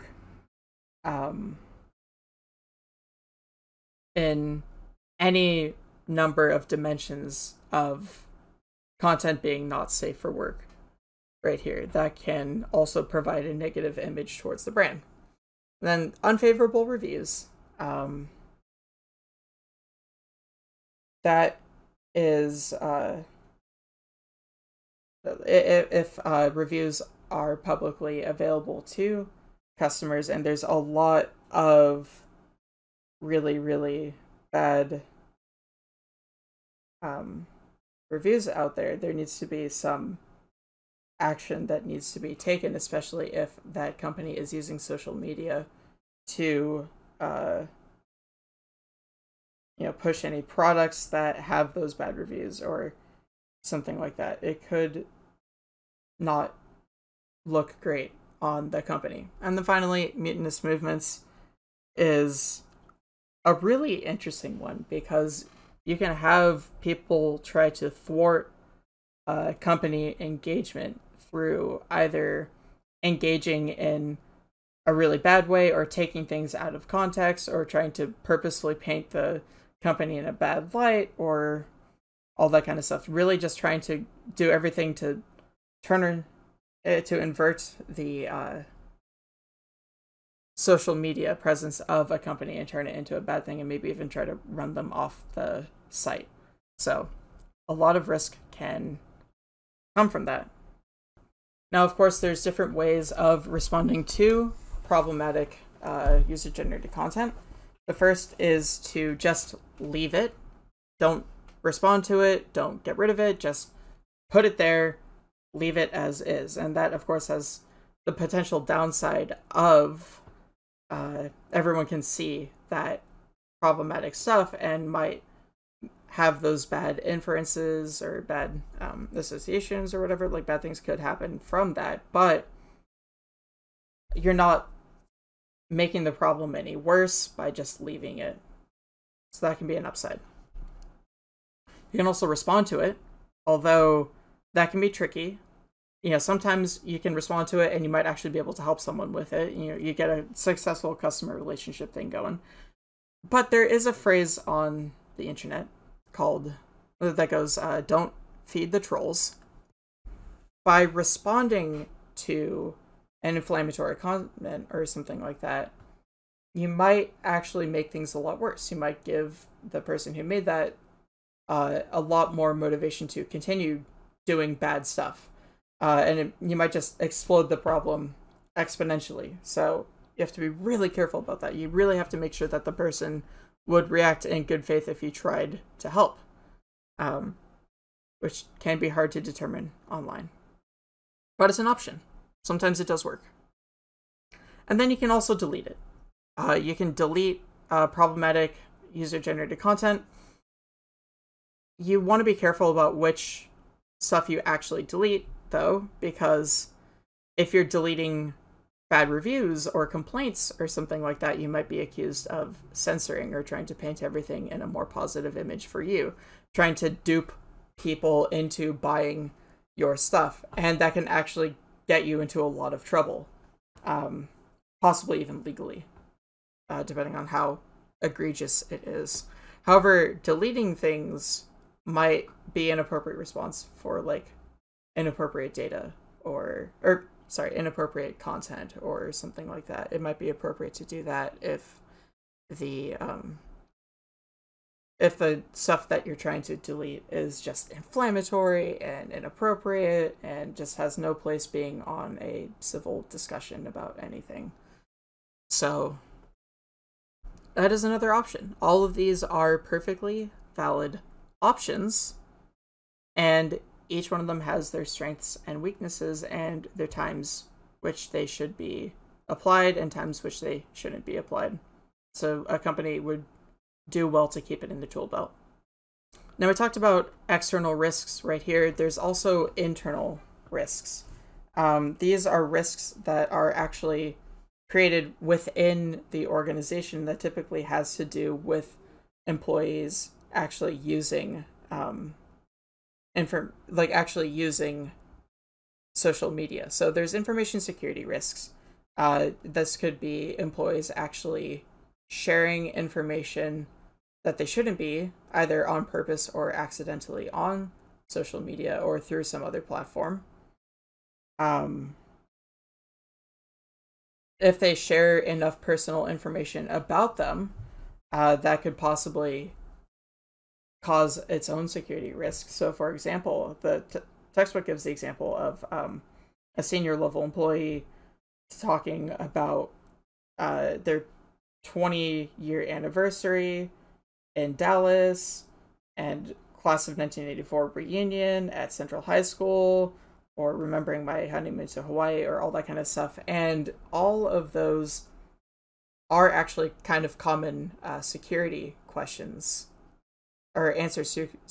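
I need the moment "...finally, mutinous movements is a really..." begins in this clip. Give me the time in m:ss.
0:59.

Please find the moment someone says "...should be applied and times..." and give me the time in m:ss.
4:28.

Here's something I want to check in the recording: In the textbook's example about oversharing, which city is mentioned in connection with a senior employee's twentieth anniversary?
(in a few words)
Dallas.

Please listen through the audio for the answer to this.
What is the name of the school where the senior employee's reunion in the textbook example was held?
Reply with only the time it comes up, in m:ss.
5:38.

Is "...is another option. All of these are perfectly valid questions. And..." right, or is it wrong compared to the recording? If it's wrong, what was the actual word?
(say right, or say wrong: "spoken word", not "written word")
wrong: "options", not "questions".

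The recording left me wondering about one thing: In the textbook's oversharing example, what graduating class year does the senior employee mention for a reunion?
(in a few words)
1984.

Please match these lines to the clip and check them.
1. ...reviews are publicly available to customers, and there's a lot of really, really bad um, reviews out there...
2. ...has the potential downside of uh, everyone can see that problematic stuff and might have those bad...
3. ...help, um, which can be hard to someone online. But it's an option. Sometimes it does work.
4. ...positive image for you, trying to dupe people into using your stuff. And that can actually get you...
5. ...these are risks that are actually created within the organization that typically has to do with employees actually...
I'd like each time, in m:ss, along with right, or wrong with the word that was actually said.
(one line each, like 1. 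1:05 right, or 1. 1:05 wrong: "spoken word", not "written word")
1. 0:26 right
2. 1:57 right
3. 3:05 wrong: "determine", not "someone"
4. 3:34 wrong: "buying", not "using"
5. 4:41 right.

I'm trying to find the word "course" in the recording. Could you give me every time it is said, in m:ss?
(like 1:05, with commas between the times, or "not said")
1:41, 1:57.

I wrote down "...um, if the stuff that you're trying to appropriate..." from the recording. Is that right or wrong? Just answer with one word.
wrong.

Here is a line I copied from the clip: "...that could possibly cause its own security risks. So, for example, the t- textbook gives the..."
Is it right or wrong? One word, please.
right.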